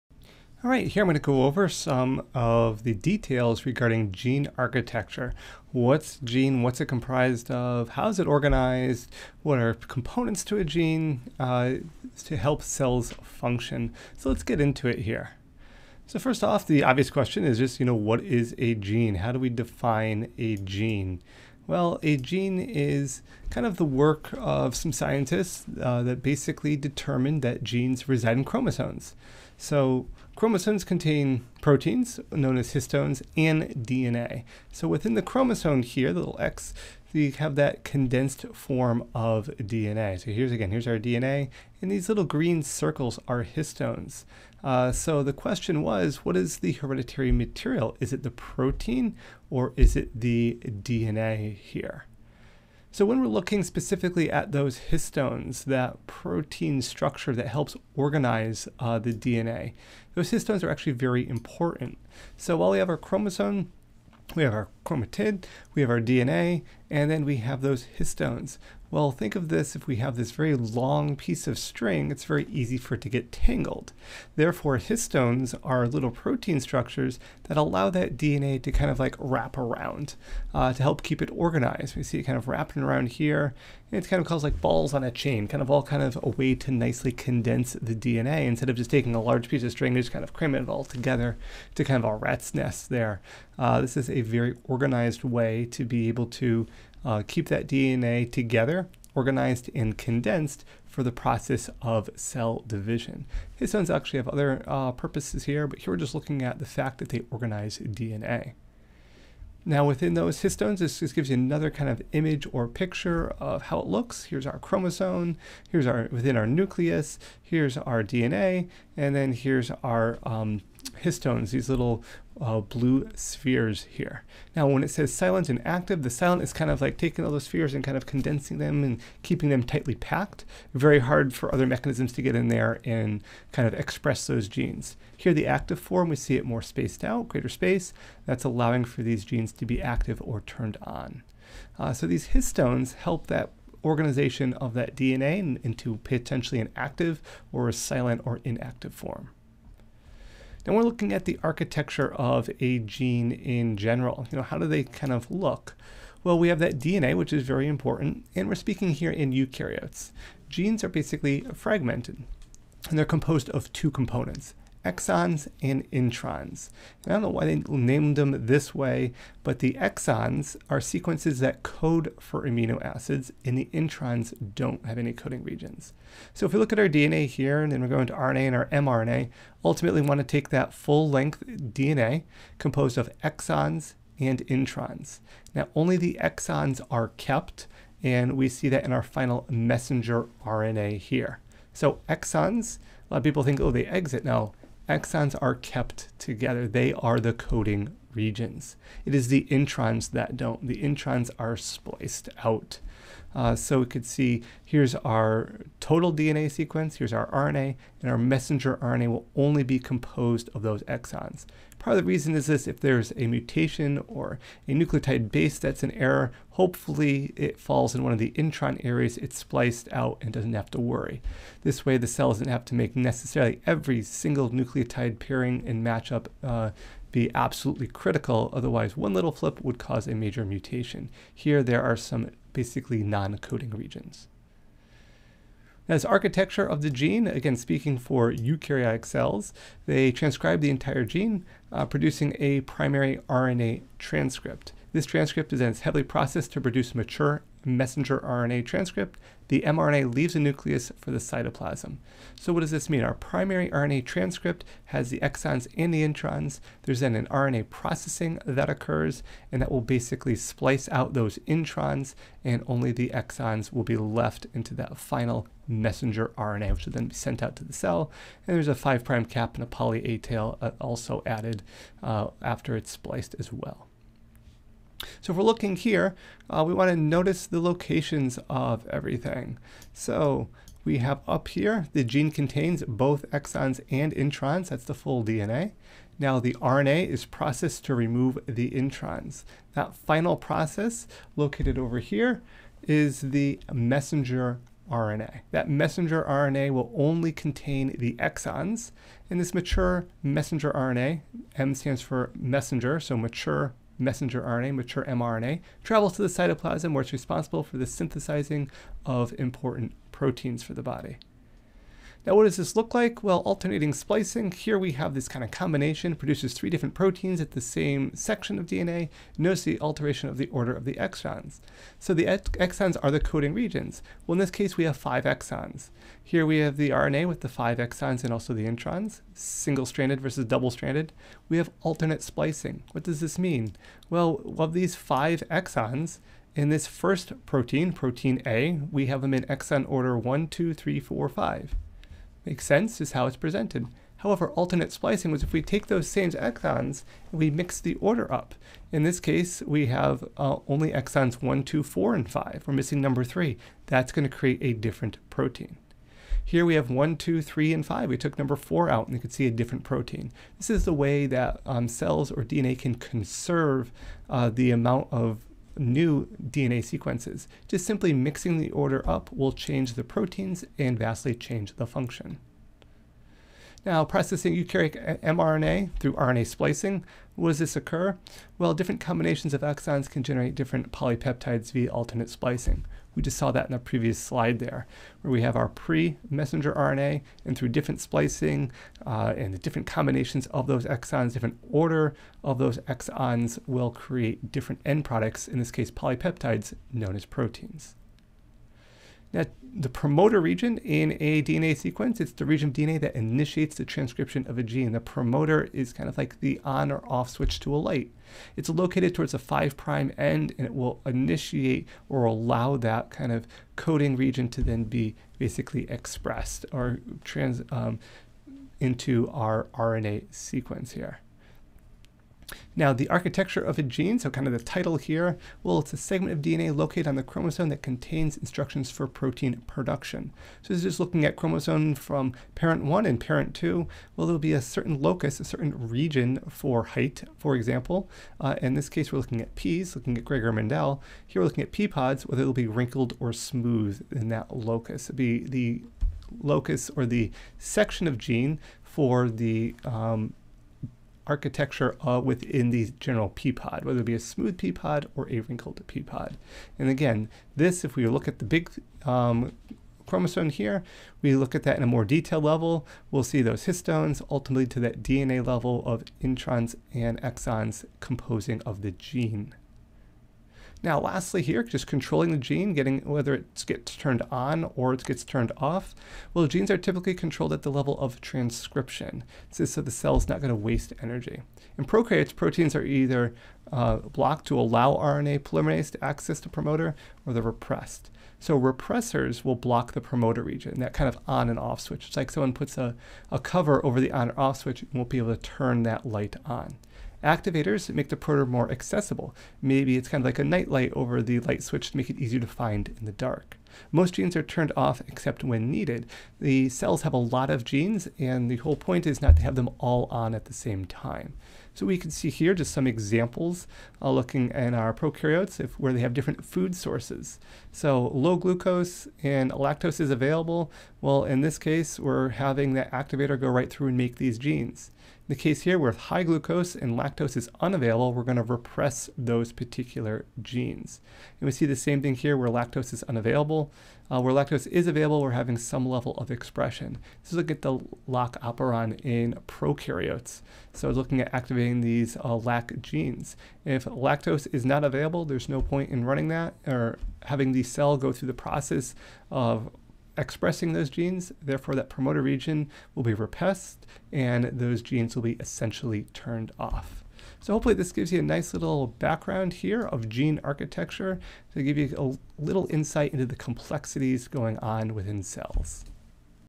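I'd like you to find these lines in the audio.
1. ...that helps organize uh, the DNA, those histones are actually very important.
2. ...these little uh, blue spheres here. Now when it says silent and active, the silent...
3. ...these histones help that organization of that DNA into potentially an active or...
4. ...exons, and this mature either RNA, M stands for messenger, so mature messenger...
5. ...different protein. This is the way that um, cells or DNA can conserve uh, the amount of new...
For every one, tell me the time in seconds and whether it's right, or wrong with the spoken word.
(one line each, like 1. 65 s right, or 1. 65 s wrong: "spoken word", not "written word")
1. 57 s right
2. 121 s right
3. 142 s right
4. 298 s wrong: "messenger", not "either"
5. 359 s right.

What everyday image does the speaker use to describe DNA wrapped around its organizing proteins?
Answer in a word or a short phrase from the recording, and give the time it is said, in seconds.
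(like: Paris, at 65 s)
balls on a chain, at 84 s.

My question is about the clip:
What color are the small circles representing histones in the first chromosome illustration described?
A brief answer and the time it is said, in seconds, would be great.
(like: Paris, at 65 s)
green, at 42 s.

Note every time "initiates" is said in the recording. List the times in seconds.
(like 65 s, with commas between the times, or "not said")
403 s, 411 s.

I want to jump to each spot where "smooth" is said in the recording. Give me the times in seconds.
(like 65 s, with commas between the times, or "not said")
443 s, 454 s.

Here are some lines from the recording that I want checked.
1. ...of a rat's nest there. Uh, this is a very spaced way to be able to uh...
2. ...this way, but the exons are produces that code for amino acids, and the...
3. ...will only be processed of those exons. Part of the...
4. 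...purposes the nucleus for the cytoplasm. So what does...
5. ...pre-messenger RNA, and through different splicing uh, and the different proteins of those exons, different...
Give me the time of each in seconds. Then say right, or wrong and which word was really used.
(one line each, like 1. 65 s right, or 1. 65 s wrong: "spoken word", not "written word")
1. 92 s wrong: "organized", not "spaced"
2. 168 s wrong: "sequences", not "produces"
3. 209 s wrong: "composed", not "processed"
4. 250 s wrong: "leaves", not "purposes"
5. 385 s wrong: "combinations", not "proteins".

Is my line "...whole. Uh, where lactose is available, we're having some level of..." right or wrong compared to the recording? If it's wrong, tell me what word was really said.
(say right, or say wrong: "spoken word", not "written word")
wrong: "unavailable", not "whole".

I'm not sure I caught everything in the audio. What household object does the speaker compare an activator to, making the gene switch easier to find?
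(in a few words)
a nightlight.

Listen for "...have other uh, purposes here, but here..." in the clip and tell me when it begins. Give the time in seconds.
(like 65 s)
104 s.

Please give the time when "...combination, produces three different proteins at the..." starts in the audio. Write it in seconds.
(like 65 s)
315 s.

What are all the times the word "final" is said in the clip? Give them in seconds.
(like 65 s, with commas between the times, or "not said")
189 s, 264 s, 289 s.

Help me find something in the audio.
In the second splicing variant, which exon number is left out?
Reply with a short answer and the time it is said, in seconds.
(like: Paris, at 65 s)
3, at 352 s.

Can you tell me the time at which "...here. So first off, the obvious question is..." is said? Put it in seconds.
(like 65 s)
14 s.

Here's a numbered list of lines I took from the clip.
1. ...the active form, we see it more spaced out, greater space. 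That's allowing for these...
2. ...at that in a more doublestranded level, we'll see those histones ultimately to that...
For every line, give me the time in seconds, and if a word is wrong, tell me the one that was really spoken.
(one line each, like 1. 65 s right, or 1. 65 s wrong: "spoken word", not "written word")
1. 135 s right
2. 461 s wrong: "detailed", not "doublestranded".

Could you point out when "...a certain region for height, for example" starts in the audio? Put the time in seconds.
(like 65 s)
435 s.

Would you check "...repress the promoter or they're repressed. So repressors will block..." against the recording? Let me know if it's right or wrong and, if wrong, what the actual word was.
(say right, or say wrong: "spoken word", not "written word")
wrong: "access", not "repress".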